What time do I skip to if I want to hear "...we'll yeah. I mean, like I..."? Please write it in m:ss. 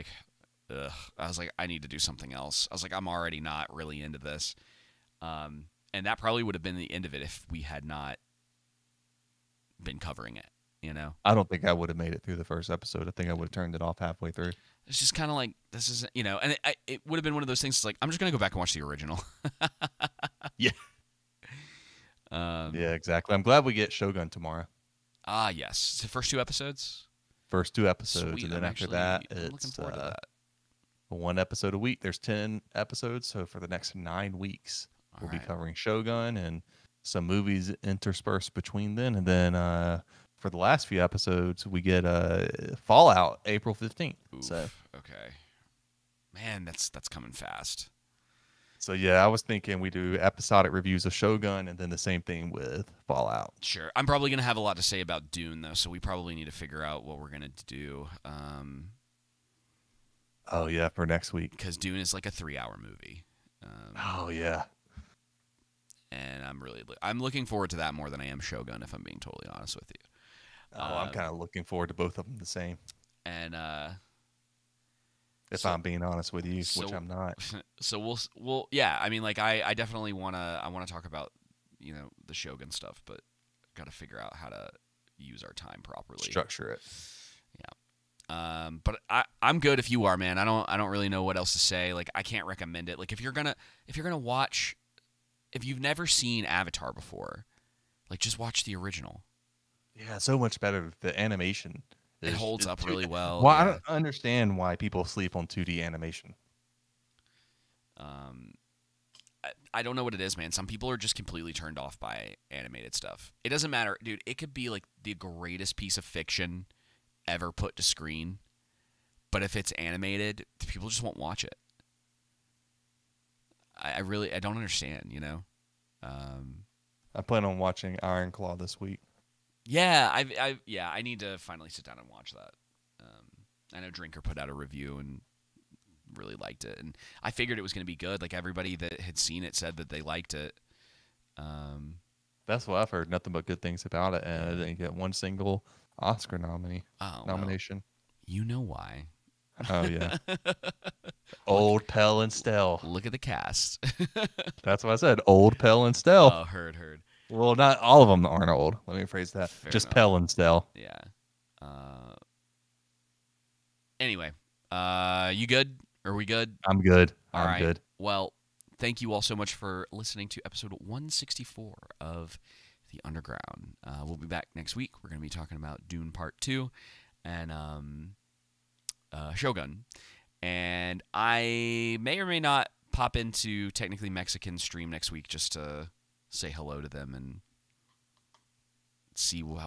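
1:18.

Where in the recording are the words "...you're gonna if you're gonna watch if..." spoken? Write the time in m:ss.
1:33.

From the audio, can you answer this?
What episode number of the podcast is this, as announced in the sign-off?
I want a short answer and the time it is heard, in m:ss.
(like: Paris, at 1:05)
164, at 2:50.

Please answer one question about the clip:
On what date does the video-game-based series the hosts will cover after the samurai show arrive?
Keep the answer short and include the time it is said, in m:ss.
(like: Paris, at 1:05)
April 15th, at 0:43.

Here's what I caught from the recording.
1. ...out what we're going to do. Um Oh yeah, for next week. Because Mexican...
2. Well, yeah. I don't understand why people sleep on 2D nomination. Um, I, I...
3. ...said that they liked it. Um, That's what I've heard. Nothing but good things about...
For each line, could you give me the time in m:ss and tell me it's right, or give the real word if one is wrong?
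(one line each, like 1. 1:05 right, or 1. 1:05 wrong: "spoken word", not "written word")
1. 0:56 wrong: "Dune", not "Mexican"
2. 1:43 wrong: "animation", not "nomination"
3. 2:19 right.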